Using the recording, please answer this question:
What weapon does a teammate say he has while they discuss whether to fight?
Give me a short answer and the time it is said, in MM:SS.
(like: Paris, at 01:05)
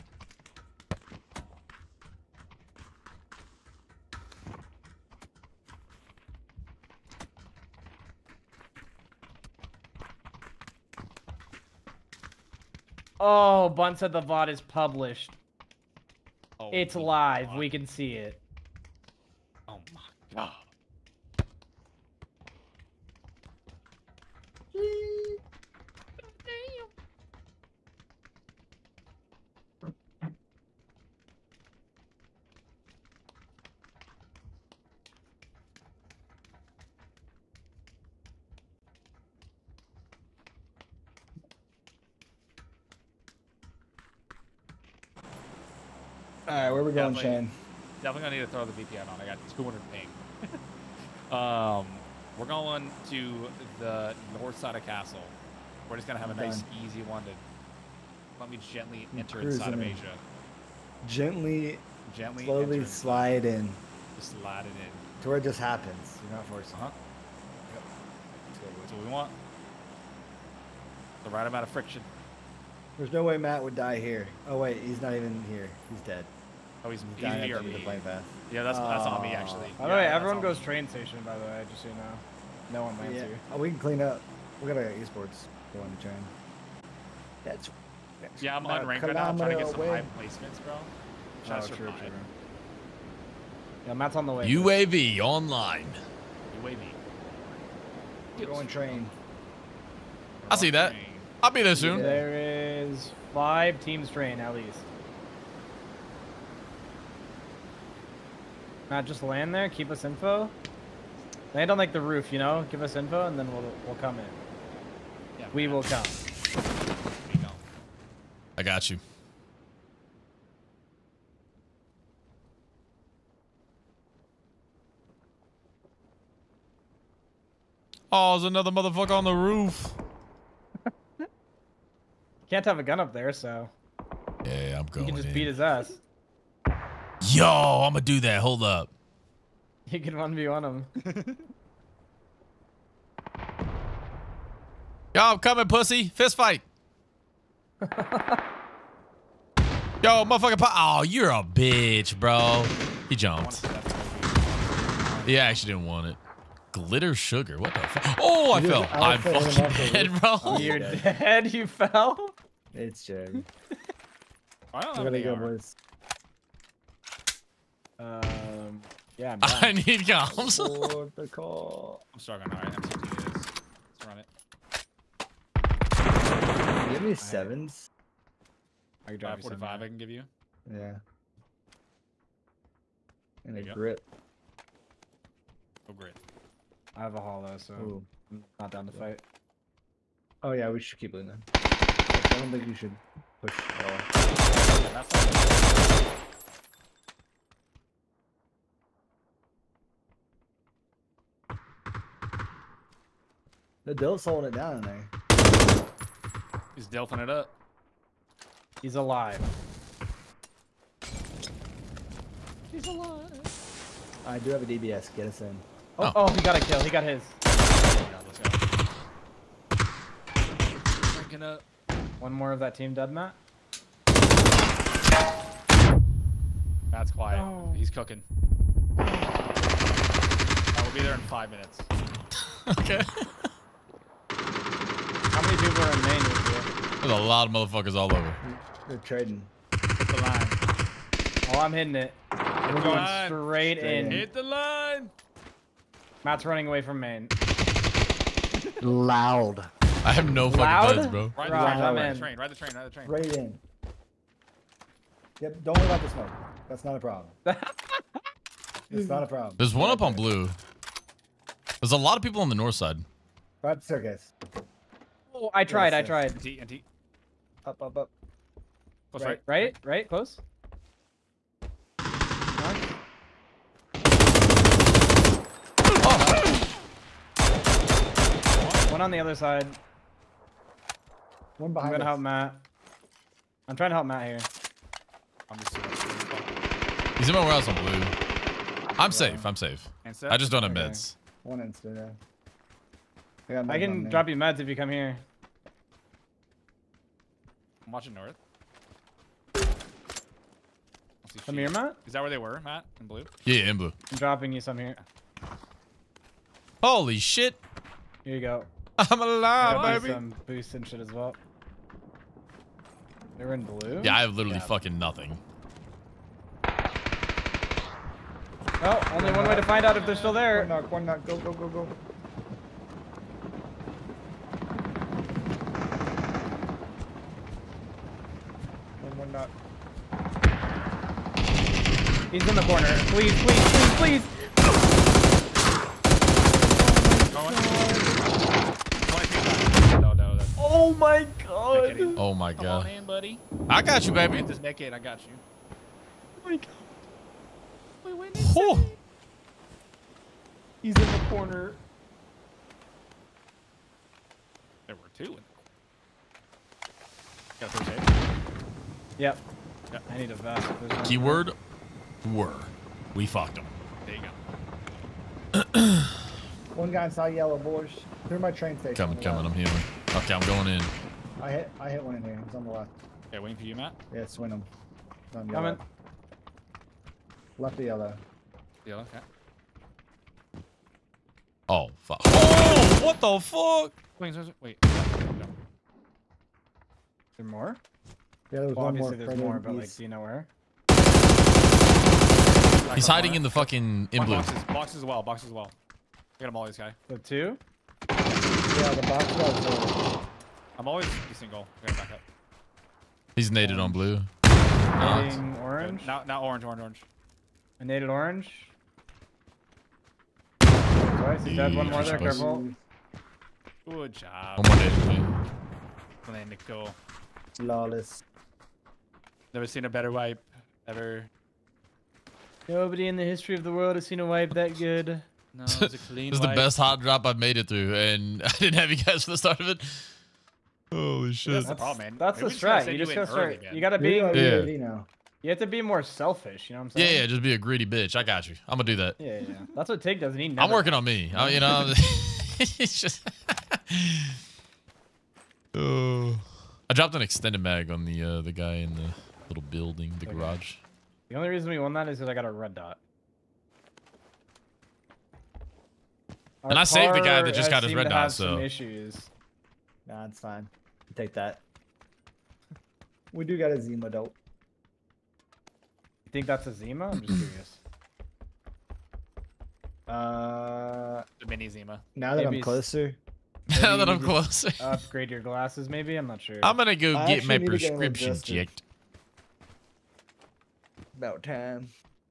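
A hollow, at 03:07.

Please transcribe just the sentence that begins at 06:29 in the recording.
there's more, but, like, do you know where?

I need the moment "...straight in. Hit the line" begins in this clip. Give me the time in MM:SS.
04:03.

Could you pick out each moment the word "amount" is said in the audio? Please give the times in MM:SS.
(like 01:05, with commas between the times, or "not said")
01:11.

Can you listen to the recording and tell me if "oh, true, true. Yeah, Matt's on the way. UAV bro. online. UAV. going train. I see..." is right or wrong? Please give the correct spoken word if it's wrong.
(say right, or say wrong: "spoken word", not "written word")
right.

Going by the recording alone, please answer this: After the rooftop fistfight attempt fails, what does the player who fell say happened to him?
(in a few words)
I fell.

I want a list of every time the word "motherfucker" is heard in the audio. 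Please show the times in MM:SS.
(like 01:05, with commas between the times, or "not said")
02:08, 02:30, 03:57.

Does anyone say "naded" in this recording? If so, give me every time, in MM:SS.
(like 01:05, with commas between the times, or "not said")
06:43, 06:47, 06:54.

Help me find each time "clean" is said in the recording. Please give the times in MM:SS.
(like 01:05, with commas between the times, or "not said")
01:23, 07:05.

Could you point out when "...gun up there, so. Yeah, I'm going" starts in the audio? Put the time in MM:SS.
02:12.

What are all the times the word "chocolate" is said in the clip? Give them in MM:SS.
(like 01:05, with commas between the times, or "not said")
not said.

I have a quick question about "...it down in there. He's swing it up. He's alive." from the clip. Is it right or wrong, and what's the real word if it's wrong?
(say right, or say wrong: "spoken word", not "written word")
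wrong: "delphing", not "swing".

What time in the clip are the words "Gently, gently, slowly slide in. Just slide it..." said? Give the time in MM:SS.
01:01.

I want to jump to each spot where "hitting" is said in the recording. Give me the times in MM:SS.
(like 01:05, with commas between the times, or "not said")
04:01.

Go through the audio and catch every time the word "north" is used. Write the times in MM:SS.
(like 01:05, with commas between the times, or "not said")
00:54, 04:22, 04:58.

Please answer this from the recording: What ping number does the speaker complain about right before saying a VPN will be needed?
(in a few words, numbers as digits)
200.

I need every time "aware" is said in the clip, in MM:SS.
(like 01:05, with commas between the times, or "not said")
not said.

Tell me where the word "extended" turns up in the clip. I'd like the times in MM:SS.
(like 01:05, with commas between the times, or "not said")
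07:27.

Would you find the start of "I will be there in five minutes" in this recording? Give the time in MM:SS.
03:48.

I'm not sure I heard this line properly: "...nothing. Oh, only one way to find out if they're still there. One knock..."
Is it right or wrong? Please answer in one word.
right.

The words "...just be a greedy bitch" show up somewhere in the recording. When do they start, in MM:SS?
07:17.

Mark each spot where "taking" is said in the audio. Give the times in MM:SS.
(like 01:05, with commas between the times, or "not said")
02:52.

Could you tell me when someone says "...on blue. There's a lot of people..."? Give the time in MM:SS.
04:20.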